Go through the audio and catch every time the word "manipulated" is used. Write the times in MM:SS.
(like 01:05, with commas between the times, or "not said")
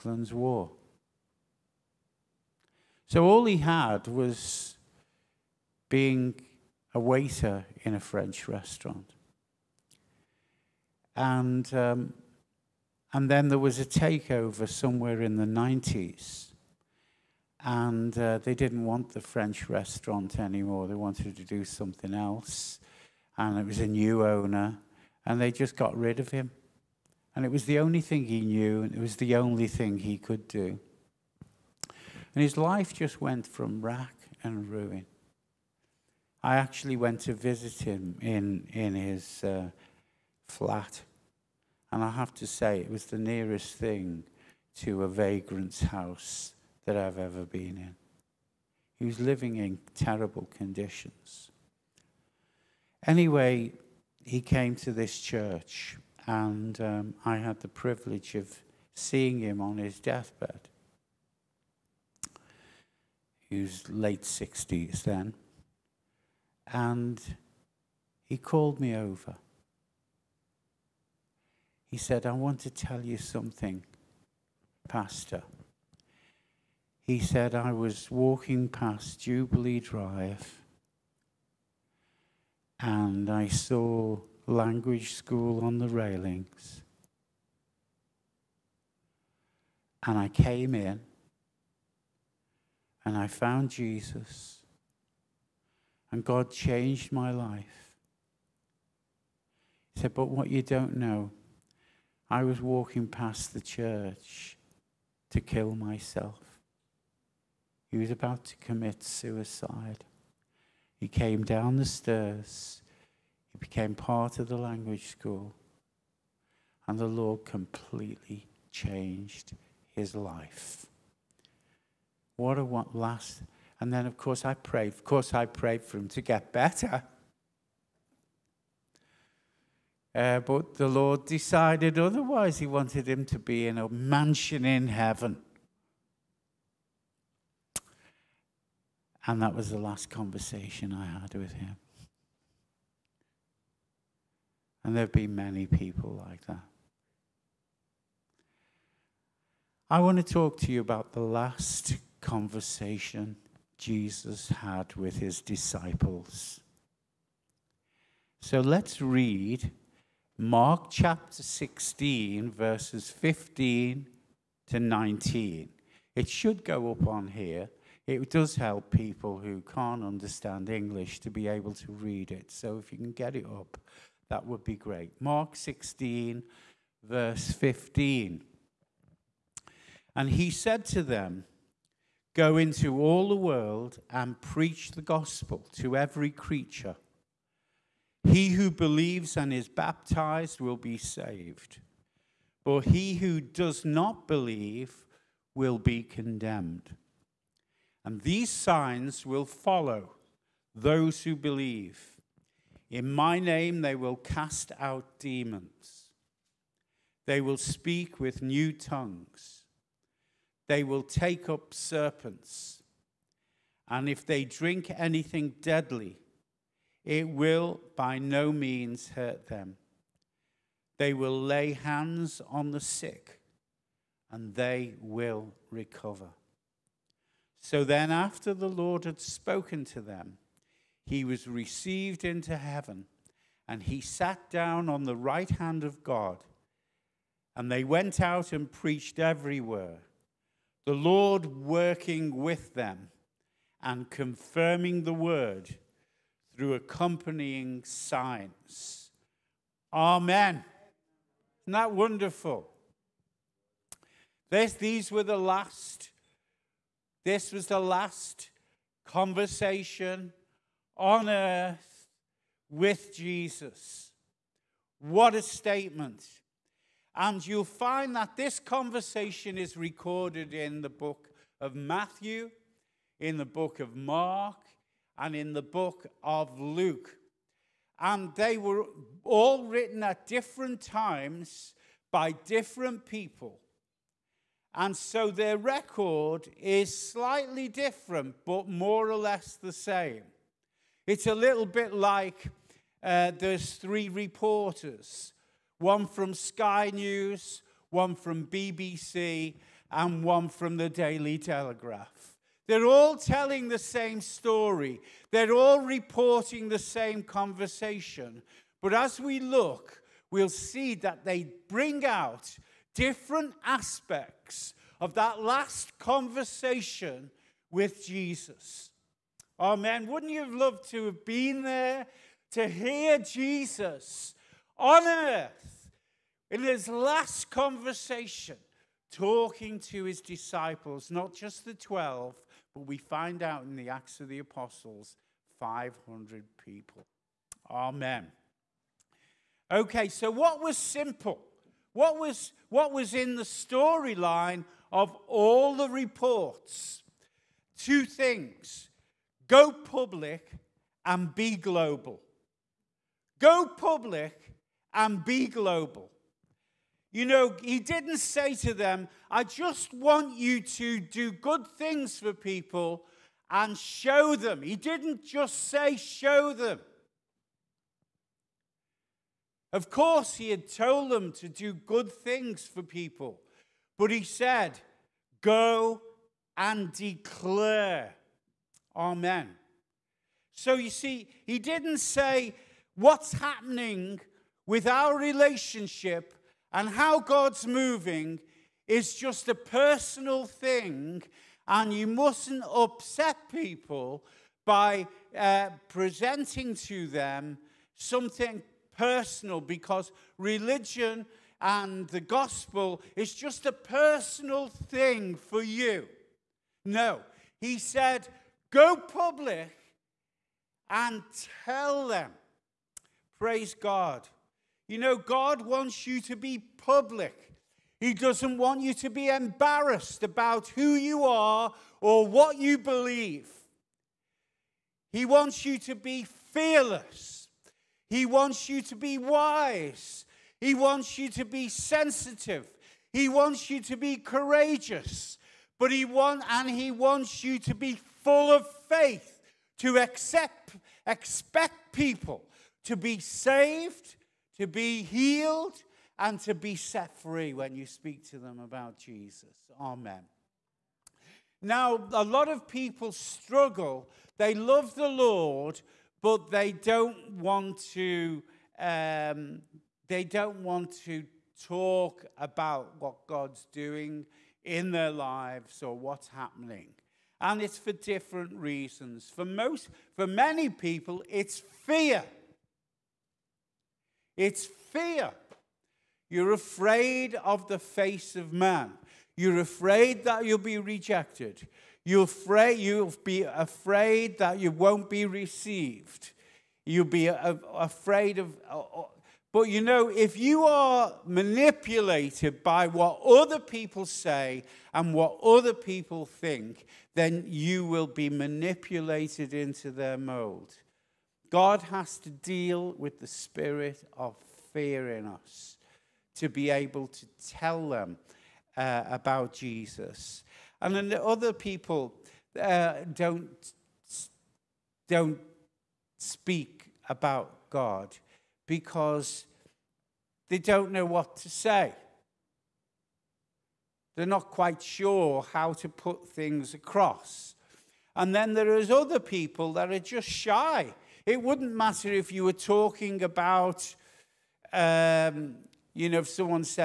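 08:11, 08:18.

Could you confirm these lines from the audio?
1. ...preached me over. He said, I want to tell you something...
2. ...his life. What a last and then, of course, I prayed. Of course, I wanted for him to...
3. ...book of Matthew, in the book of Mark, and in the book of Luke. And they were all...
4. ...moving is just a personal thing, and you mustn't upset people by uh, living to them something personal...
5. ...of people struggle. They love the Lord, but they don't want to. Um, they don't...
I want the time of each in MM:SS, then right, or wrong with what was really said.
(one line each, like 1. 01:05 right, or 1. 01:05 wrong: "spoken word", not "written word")
1. 01:08 wrong: "called", not "preached"
2. 01:59 wrong: "prayed", not "wanted"
3. 04:30 right
4. 06:27 wrong: "presenting", not "living"
5. 07:32 right.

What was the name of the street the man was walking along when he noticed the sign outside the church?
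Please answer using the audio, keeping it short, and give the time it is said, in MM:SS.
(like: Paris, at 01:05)
Jubilee Drive, at 01:19.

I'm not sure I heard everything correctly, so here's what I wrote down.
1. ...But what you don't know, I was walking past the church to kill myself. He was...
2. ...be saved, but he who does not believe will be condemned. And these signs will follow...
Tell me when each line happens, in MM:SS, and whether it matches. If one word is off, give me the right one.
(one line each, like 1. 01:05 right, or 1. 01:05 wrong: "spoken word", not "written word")
1. 01:40 right
2. 03:10 right.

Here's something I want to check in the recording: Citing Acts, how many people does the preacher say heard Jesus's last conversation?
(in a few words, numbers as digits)
500.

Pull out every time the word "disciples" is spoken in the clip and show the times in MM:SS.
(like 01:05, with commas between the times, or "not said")
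02:35, 05:30.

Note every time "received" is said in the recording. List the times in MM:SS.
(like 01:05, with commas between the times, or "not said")
03:51, 08:05.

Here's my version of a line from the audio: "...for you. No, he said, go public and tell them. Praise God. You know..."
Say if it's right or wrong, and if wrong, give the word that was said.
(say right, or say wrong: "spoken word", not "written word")
right.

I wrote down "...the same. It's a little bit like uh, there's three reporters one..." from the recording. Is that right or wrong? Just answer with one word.
right.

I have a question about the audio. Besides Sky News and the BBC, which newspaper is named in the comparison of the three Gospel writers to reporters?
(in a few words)
Daily Telegraph.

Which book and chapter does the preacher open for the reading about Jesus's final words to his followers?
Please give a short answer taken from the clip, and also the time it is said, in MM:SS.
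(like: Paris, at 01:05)
Mark 16, at 02:40.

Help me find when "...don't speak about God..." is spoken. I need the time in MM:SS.
08:35.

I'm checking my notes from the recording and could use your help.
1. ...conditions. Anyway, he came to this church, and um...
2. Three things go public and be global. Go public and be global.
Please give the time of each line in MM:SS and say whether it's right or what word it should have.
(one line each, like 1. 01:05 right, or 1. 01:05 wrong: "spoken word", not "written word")
1. 00:50 right
2. 05:47 wrong: "Two", not "Three".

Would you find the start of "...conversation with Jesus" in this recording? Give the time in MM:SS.
05:15.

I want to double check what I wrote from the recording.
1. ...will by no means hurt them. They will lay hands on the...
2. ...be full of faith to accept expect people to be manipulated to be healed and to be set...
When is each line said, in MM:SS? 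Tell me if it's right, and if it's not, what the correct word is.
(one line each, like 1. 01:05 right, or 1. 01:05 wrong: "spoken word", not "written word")
1. 03:37 right
2. 07:17 wrong: "saved", not "manipulated".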